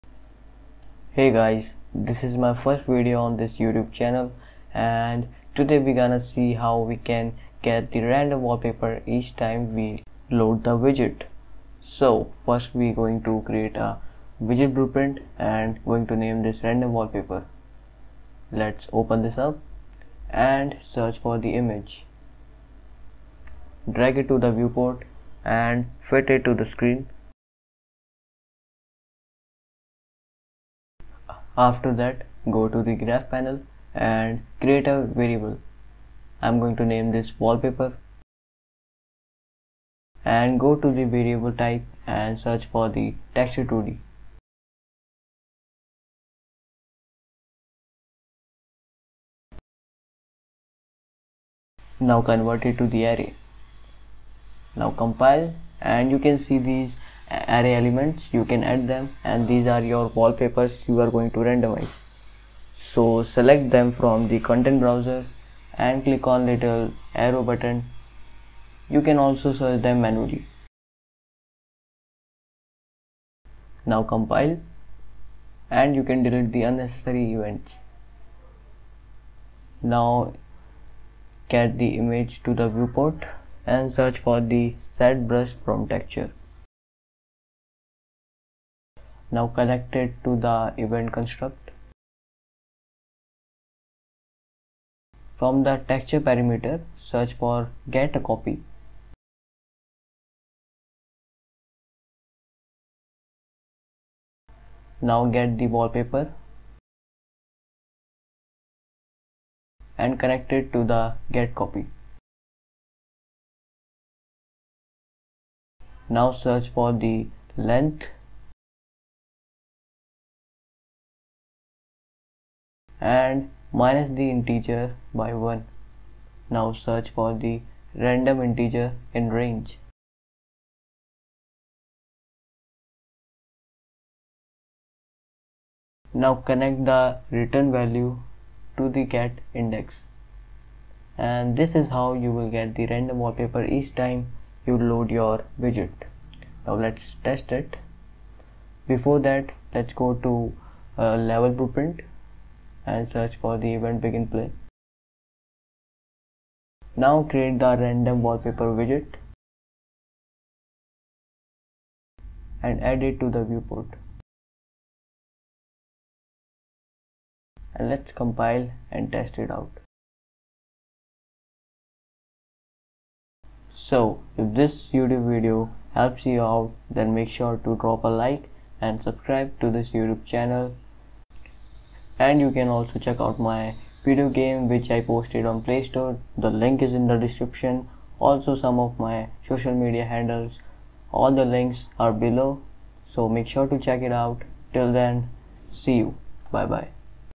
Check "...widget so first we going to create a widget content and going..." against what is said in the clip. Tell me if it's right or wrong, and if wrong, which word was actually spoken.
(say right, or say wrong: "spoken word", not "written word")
wrong: "blueprint", not "content".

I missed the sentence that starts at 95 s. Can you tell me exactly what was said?
From the texture parameter, search for get a copy.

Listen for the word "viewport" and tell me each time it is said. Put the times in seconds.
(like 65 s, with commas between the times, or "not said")
24 s, 82 s, 163 s.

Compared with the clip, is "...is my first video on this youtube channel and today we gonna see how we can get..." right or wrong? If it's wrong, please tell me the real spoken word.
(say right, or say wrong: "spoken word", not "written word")
right.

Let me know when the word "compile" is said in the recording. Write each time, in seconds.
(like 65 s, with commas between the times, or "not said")
55 s, 74 s, 168 s.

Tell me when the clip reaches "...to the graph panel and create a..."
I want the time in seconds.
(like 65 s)
32 s.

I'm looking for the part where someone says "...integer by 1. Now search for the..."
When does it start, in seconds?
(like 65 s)
124 s.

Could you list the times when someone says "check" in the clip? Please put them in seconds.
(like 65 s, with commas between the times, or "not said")
182 s, 193 s.